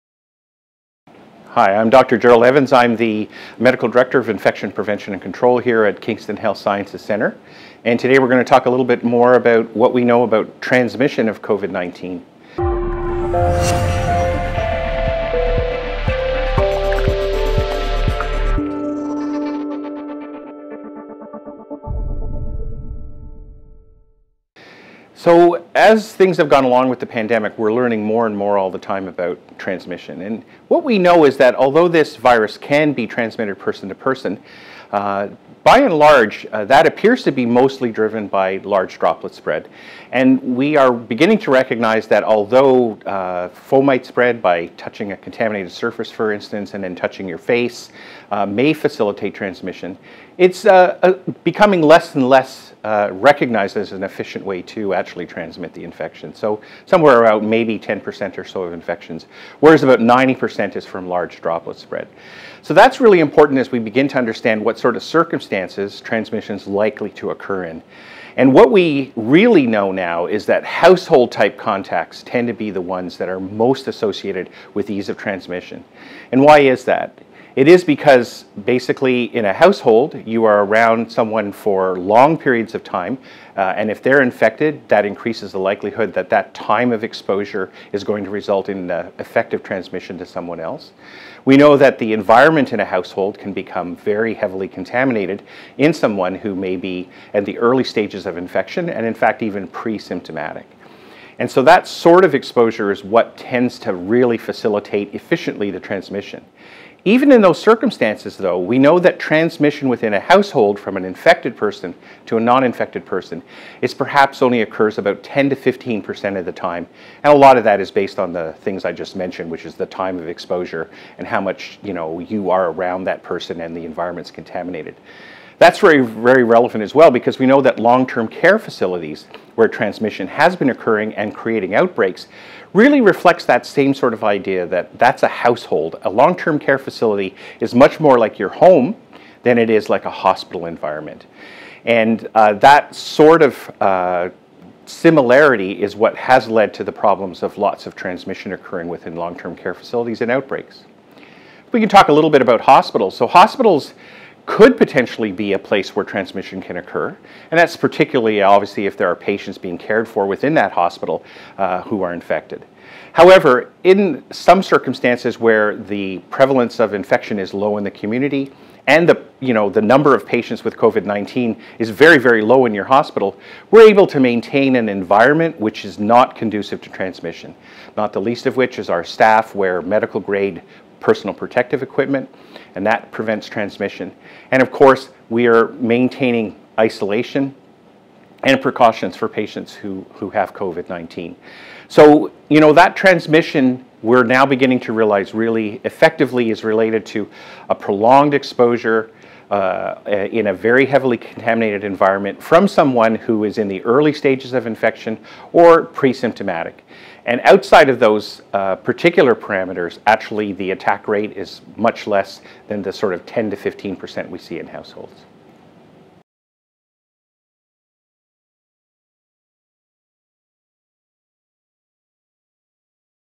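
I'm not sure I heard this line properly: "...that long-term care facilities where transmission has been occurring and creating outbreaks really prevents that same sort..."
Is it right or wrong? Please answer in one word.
wrong.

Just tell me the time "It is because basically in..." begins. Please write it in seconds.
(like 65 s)
77 s.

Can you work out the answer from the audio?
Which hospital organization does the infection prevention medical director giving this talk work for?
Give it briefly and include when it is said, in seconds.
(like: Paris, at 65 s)
Kingston Health Sciences Center, at 5 s.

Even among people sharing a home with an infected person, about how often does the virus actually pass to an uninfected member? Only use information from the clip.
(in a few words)
10 to 15 percent.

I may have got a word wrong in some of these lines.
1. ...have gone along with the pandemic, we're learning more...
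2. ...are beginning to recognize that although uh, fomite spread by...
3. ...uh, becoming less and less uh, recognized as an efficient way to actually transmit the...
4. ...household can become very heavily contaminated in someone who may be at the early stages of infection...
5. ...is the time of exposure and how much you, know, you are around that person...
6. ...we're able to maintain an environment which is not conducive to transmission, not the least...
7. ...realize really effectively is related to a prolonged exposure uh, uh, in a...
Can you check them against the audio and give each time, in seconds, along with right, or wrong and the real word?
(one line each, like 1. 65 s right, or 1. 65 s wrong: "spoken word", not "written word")
1. 26 s right
2. 40 s right
3. 51 s right
4. 92 s right
5. 119 s right
6. 173 s right
7. 194 s right.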